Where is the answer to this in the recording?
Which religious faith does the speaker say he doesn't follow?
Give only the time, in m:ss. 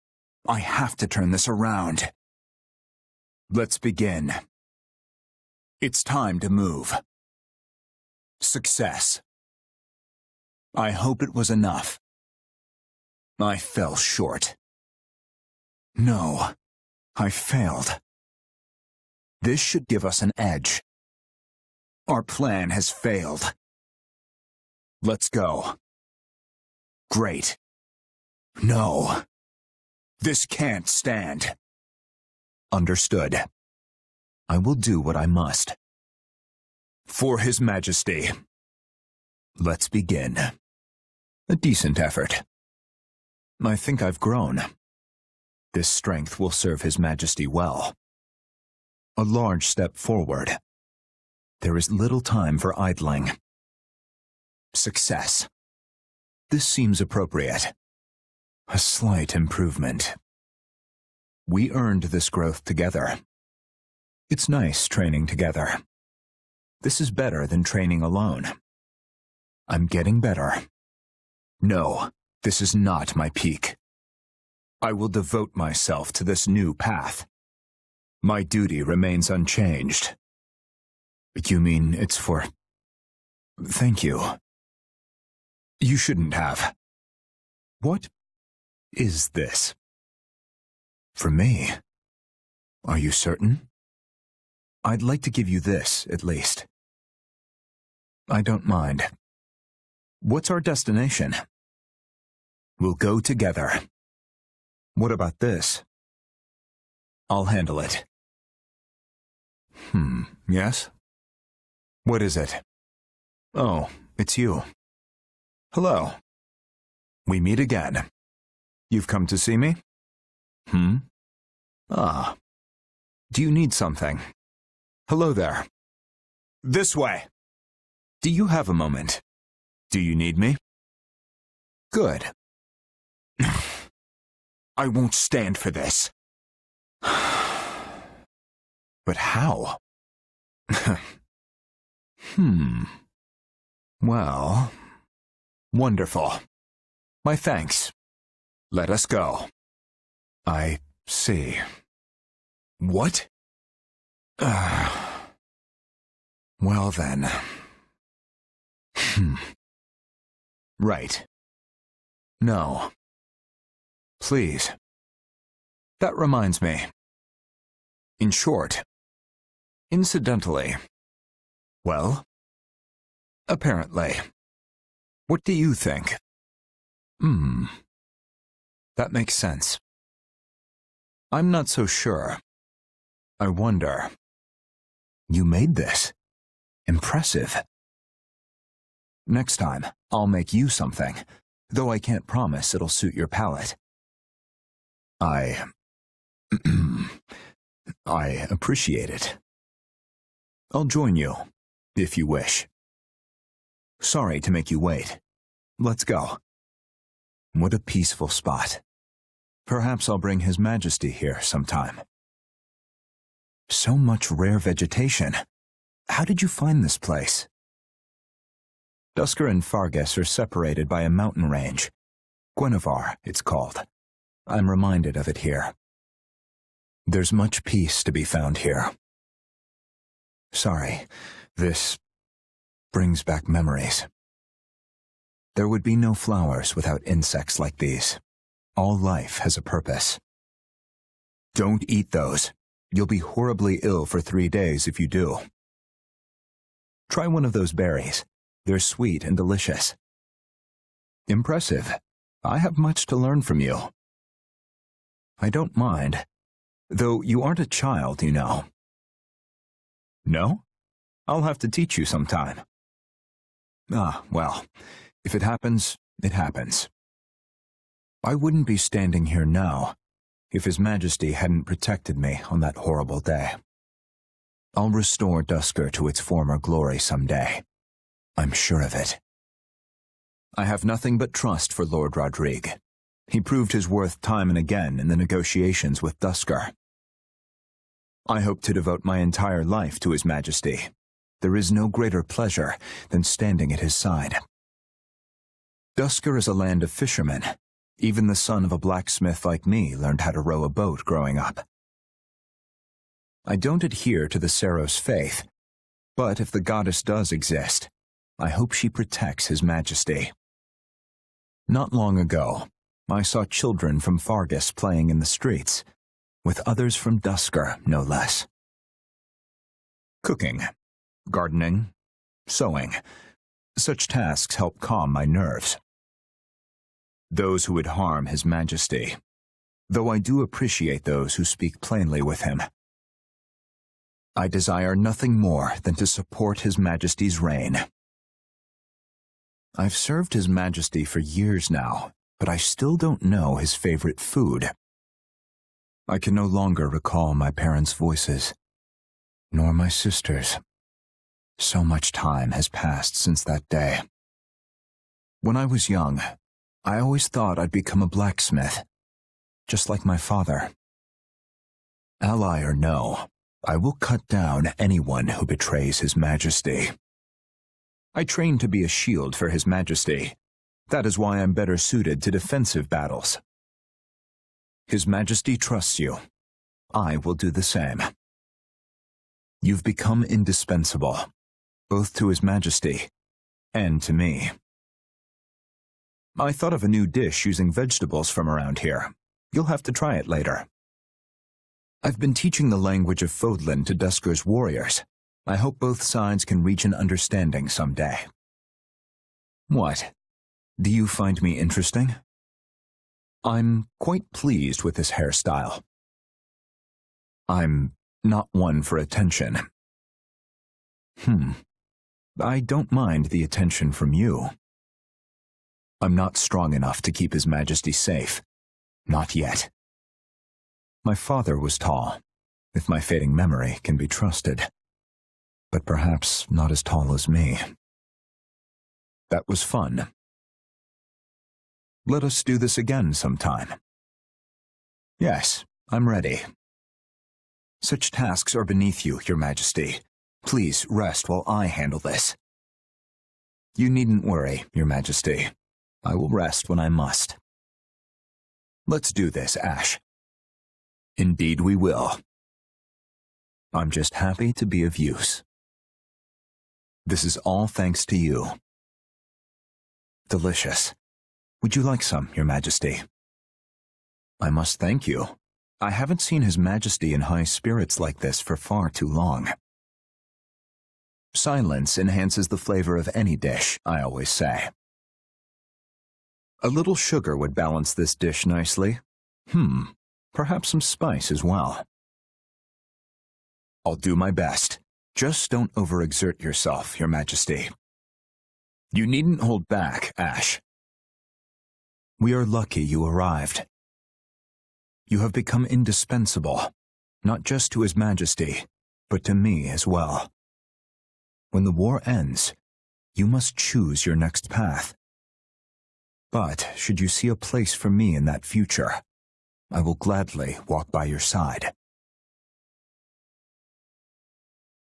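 5:04.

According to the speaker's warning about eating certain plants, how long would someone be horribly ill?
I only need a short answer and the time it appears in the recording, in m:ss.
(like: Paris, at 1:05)
3 days, at 4:04.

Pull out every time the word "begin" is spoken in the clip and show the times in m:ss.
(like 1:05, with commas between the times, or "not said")
0:03, 0:39.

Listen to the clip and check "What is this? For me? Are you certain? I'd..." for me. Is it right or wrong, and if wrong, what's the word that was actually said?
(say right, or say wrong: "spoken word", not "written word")
right.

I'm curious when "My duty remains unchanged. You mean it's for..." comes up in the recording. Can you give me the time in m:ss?
1:18.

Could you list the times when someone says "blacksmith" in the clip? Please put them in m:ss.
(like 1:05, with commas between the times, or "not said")
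4:58, 5:58.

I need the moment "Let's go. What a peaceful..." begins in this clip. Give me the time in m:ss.
3:25.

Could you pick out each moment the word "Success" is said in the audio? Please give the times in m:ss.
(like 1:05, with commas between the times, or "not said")
0:08, 0:54.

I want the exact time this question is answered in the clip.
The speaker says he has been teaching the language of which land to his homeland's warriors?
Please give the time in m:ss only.
6:33.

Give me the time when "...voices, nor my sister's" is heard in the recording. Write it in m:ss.
5:47.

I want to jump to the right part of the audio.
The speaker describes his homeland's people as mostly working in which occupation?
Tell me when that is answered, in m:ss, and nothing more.
4:56.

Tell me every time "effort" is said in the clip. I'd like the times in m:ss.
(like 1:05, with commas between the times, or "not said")
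0:41.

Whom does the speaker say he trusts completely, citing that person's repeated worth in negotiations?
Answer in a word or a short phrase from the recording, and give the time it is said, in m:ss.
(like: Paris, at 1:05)
Lord Rodrigue, at 4:41.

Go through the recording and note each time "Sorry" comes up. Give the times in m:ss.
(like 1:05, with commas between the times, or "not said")
3:23, 3:50.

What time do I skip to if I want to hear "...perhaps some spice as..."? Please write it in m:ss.
8:00.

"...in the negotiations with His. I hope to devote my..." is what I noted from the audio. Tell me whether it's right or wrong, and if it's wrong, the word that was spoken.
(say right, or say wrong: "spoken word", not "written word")
wrong: "Duscur", not "His".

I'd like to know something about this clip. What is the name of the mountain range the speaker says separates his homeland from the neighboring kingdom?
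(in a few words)
Guinevar.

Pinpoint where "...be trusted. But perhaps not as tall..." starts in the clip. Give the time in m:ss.
7:03.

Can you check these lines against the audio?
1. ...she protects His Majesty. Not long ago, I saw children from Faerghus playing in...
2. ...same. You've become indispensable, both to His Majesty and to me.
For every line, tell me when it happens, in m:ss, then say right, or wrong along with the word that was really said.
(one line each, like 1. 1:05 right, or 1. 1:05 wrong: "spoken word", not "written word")
1. 5:08 right
2. 6:17 right.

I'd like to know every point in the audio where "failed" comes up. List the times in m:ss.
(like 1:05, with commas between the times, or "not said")
0:17, 0:22.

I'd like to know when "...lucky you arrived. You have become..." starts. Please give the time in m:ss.
8:12.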